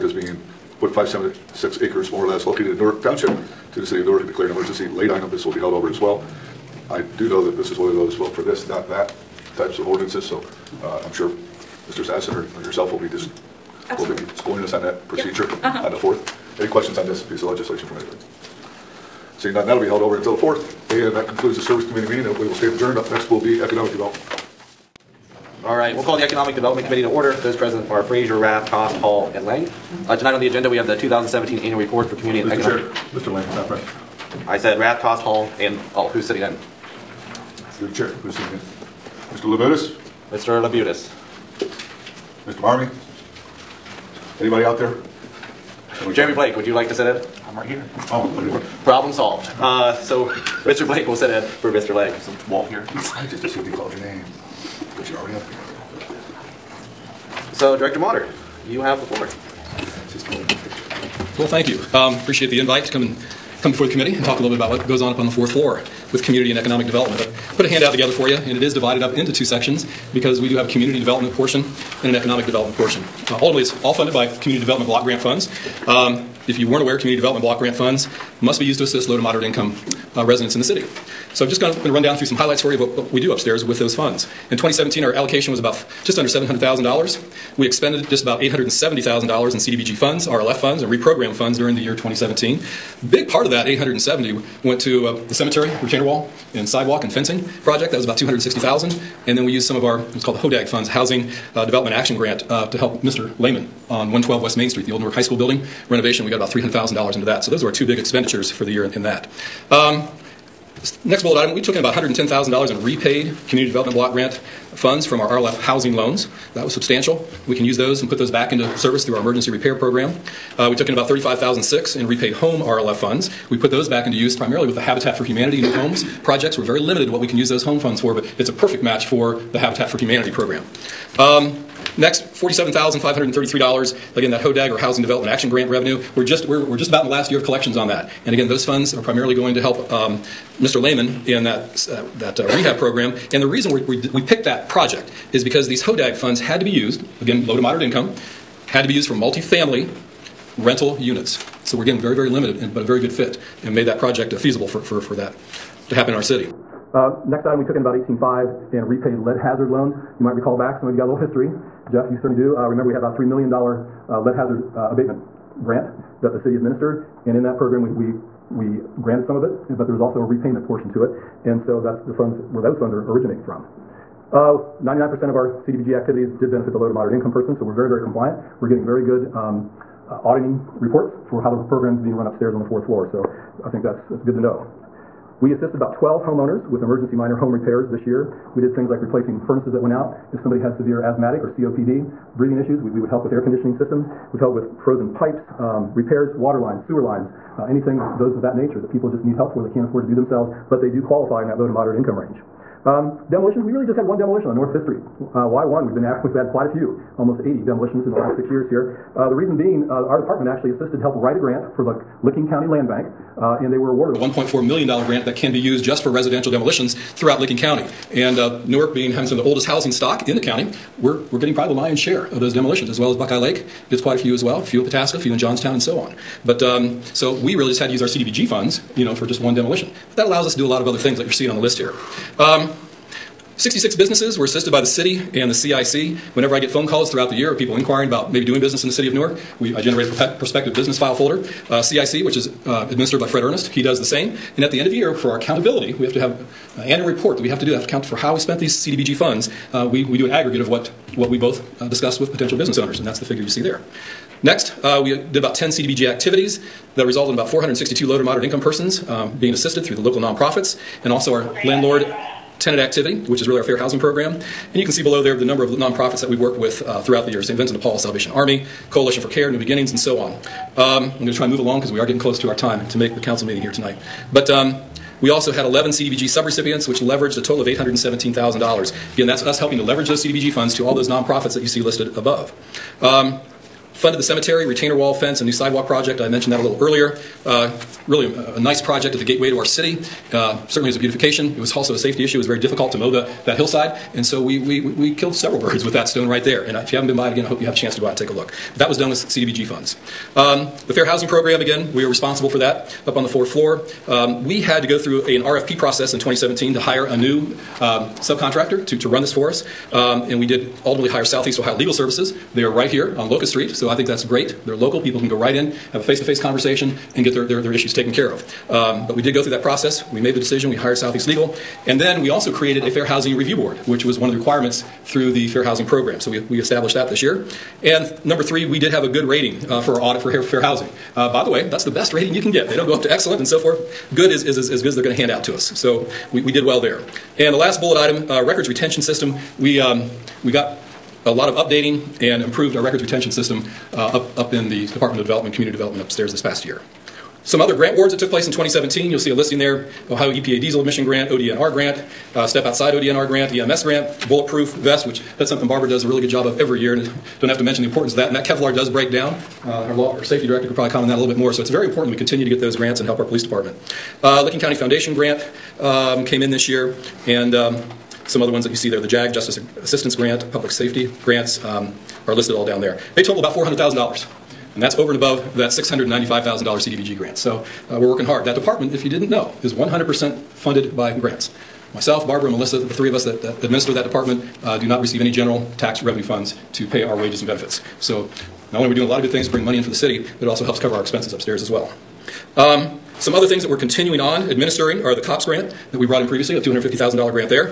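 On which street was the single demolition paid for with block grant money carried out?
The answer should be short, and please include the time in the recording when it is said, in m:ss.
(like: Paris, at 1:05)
North Fifth Street, at 3:24.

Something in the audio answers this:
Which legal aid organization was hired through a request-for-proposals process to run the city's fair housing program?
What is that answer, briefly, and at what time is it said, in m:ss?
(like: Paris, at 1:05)
Southeast Ohio Legal Services, at 5:11.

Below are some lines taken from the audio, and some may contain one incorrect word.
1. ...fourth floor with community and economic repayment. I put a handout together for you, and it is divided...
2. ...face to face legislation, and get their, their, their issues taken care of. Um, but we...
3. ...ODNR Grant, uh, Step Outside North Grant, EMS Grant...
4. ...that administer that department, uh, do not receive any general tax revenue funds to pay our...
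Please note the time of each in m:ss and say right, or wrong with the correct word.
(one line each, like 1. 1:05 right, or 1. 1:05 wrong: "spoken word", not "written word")
1. 1:05 wrong: "development", not "repayment"
2. 5:16 wrong: "conversation", not "legislation"
3. 5:51 wrong: "ODNR", not "North"
4. 6:23 right.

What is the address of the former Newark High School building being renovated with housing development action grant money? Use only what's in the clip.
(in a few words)
112 West Main Street.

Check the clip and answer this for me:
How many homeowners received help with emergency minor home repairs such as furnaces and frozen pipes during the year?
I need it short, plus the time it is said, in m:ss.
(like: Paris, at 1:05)
12, at 3:05.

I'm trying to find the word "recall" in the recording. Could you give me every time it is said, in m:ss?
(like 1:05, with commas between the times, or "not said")
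2:40.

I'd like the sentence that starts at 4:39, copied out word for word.
Again, that's us helping to leverage those CDBG funds to all those nonprofits that you see listed above.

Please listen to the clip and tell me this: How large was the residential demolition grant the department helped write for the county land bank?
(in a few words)
$1.4 million.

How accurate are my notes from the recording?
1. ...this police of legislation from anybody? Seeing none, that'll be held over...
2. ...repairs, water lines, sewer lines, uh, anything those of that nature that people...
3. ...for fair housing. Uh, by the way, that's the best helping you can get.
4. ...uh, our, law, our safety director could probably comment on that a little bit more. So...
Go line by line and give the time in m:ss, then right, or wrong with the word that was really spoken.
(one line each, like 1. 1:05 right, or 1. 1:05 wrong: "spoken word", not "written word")
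1. 0:17 wrong: "piece", not "police"
2. 3:15 right
3. 5:30 wrong: "rating", not "helping"
4. 5:59 right.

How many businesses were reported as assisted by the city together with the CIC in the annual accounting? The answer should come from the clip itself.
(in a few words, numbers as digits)
66.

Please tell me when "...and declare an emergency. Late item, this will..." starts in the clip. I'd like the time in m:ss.
0:04.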